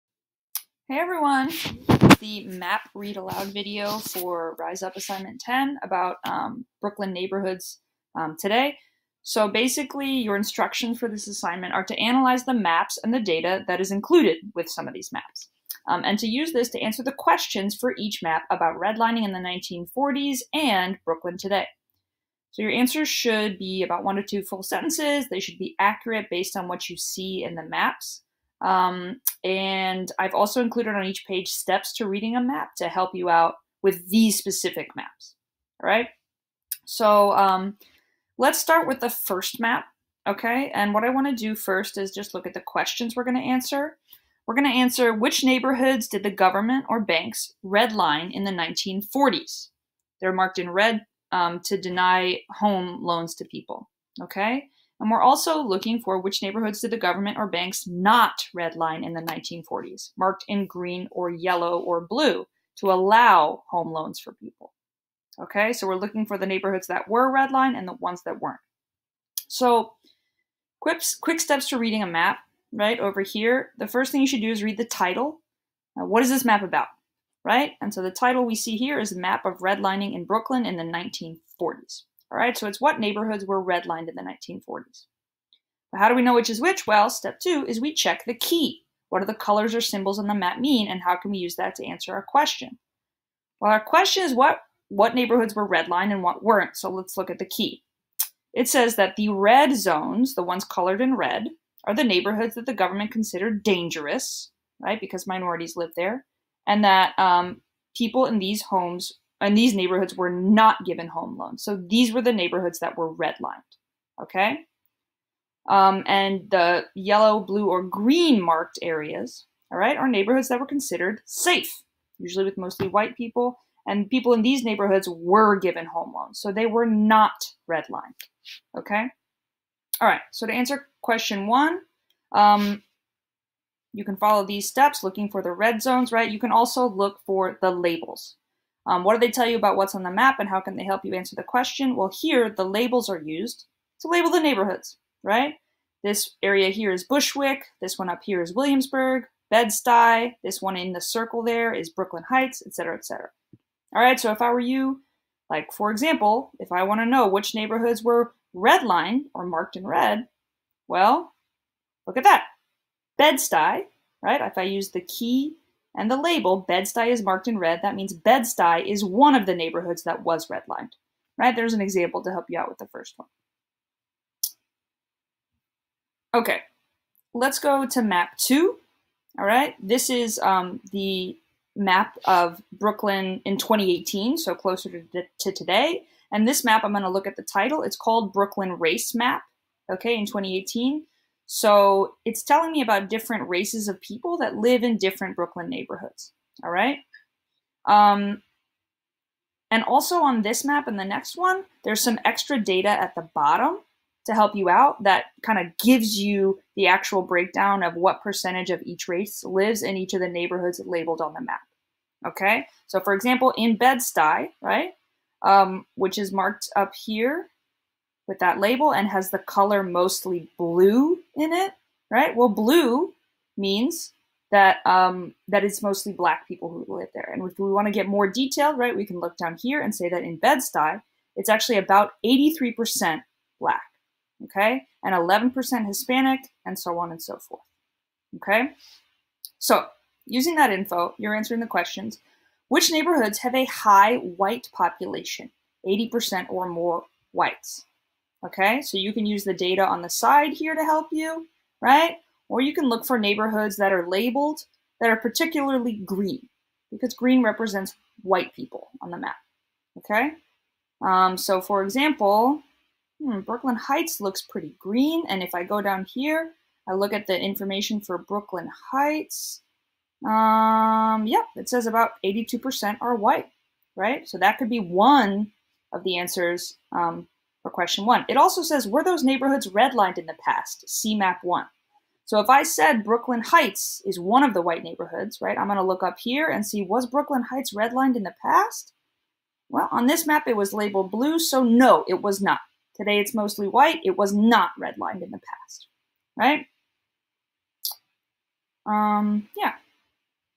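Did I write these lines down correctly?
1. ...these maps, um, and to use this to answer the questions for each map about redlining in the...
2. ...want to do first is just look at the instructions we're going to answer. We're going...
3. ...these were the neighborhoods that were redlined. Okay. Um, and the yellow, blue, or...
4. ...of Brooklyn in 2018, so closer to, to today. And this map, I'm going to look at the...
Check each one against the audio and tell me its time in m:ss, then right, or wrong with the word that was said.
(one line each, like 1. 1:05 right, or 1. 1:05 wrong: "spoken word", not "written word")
1. 0:14 right
2. 0:41 wrong: "questions", not "instructions"
3. 1:51 right
4. 3:02 right.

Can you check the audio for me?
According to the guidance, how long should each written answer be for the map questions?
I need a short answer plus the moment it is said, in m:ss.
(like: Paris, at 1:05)
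One to two full sentences, at 0:24.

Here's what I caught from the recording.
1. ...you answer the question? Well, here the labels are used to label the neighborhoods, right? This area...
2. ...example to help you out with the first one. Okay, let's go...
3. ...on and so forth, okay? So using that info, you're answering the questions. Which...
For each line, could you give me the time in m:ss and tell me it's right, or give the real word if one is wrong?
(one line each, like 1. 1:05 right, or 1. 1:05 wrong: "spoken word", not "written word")
1. 2:21 right
2. 2:51 right
3. 3:56 right.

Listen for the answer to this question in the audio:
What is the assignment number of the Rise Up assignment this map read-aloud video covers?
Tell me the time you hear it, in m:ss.
0:04.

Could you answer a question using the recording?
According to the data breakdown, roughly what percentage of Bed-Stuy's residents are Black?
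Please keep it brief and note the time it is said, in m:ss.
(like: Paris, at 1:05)
83%, at 3:52.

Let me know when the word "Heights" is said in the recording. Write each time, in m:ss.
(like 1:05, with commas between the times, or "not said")
2:32, 4:23, 4:28, 4:43, 4:47.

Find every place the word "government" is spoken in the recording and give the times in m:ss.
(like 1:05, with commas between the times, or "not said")
0:46, 0:56, 1:42.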